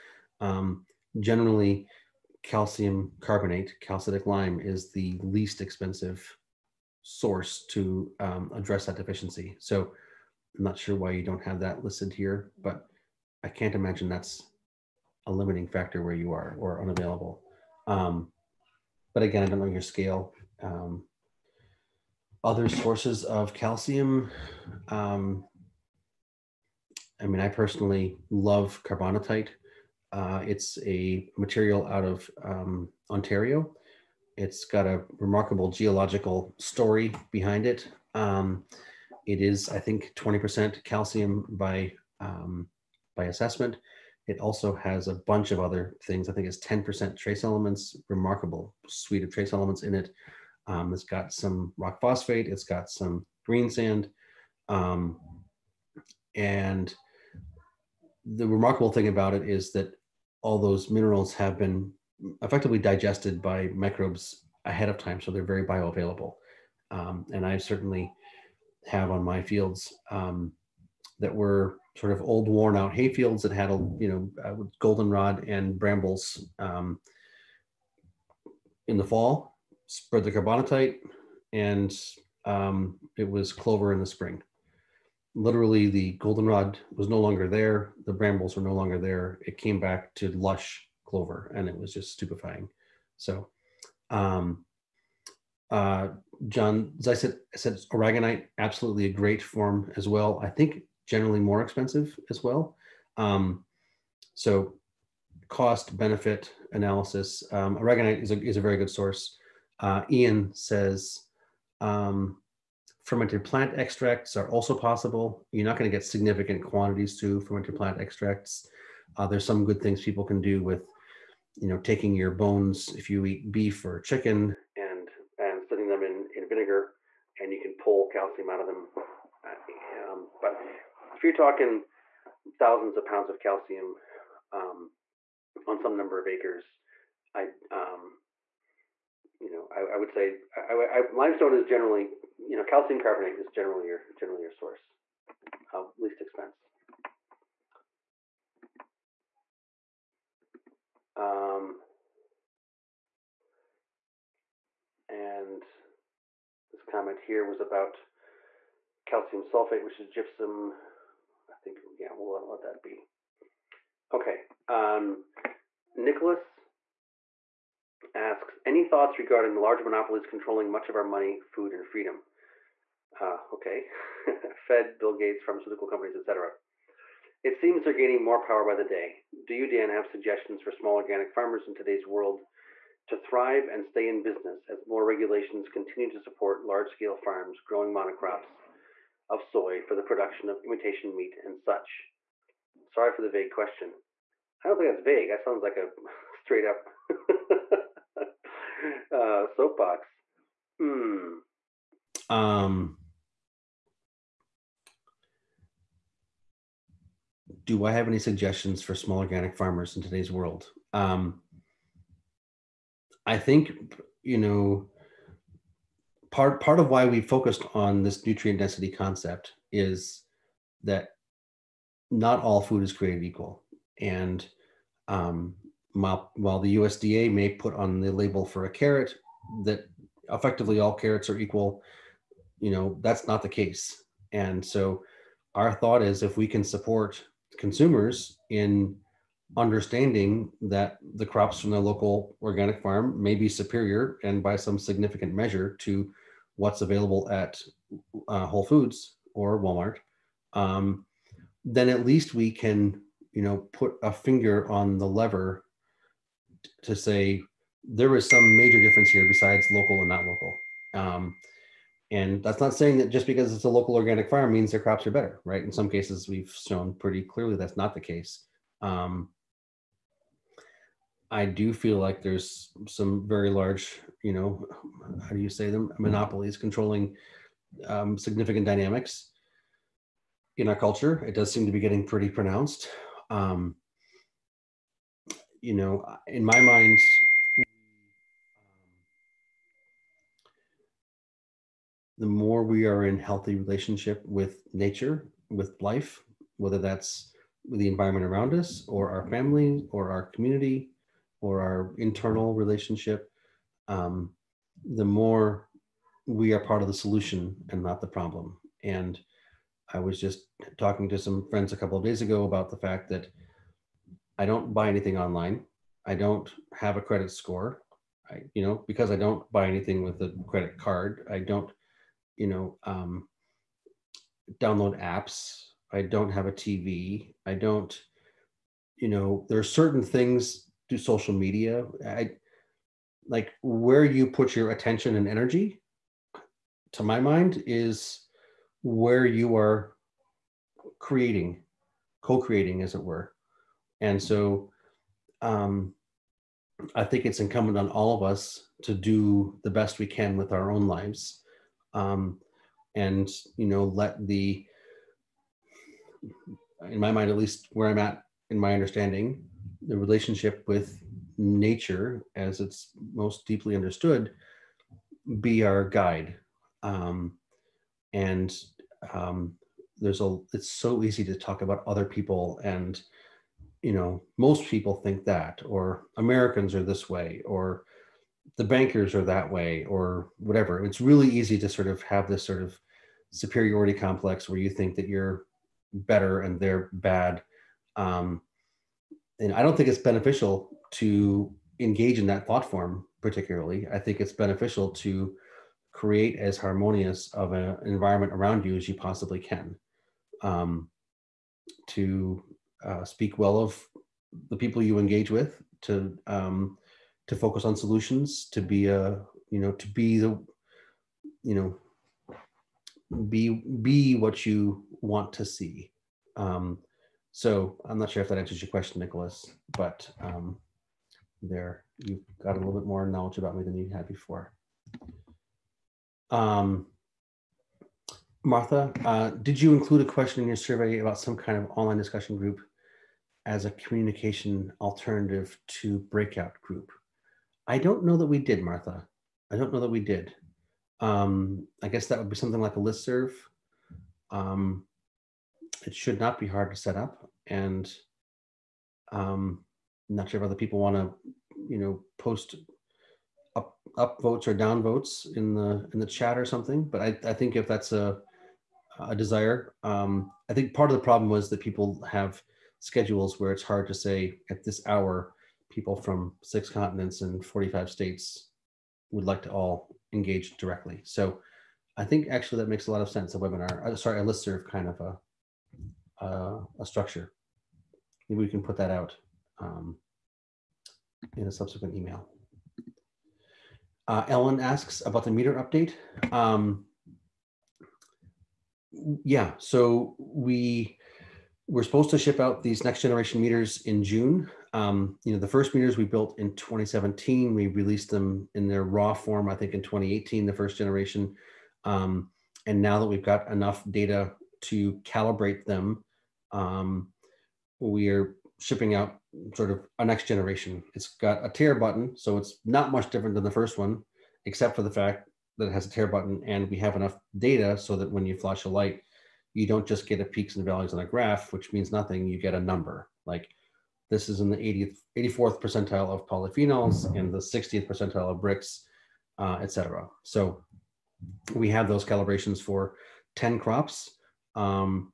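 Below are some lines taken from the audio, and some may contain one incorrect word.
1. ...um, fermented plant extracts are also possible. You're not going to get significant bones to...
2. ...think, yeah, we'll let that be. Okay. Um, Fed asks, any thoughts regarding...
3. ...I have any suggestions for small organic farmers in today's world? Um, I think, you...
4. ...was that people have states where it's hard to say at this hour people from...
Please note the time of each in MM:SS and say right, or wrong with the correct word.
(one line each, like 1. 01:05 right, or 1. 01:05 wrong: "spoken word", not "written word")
1. 01:51 wrong: "quantities", not "bones"
2. 02:41 wrong: "Nicholas", not "Fed"
3. 03:27 right
4. 07:41 wrong: "schedules", not "states".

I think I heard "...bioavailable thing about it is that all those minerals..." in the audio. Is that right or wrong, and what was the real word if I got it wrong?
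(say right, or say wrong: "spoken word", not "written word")
wrong: "remarkable", not "bioavailable".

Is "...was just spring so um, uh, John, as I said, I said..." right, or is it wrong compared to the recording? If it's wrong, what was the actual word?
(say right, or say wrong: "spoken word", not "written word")
wrong: "stupefying", not "spring".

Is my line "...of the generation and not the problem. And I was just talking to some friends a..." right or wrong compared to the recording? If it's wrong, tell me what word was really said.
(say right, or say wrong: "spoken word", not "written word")
wrong: "solution", not "generation".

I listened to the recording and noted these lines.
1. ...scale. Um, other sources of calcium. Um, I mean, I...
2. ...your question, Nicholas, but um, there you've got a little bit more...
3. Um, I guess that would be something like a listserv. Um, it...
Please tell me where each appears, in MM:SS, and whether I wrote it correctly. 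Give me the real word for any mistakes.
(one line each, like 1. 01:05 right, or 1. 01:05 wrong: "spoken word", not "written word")
1. 00:19 right
2. 06:58 right
3. 07:20 right.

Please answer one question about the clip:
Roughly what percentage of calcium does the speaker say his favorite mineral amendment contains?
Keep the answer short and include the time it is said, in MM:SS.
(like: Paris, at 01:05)
20%, at 00:40.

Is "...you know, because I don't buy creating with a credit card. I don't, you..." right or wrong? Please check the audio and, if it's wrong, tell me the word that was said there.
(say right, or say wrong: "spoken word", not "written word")
wrong: "anything", not "creating".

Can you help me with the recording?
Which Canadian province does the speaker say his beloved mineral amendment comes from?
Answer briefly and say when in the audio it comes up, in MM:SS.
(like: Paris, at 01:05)
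Ontario, at 00:33.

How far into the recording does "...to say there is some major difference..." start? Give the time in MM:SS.
04:16.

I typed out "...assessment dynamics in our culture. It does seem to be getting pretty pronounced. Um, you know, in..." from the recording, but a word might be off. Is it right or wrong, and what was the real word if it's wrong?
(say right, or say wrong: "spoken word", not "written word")
wrong: "significant", not "assessment".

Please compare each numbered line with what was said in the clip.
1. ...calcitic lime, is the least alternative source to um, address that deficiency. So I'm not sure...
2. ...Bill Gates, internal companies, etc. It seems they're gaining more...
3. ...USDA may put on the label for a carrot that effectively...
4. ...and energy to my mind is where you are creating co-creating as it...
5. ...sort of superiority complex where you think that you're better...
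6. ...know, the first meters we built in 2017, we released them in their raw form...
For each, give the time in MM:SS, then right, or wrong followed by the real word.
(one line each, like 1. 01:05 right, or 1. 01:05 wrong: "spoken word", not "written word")
1. 00:03 wrong: "expensive", not "alternative"
2. 02:54 wrong: "pharmaceutical", not "internal"
3. 03:46 right
4. 05:35 right
5. 06:22 right
6. 08:15 right.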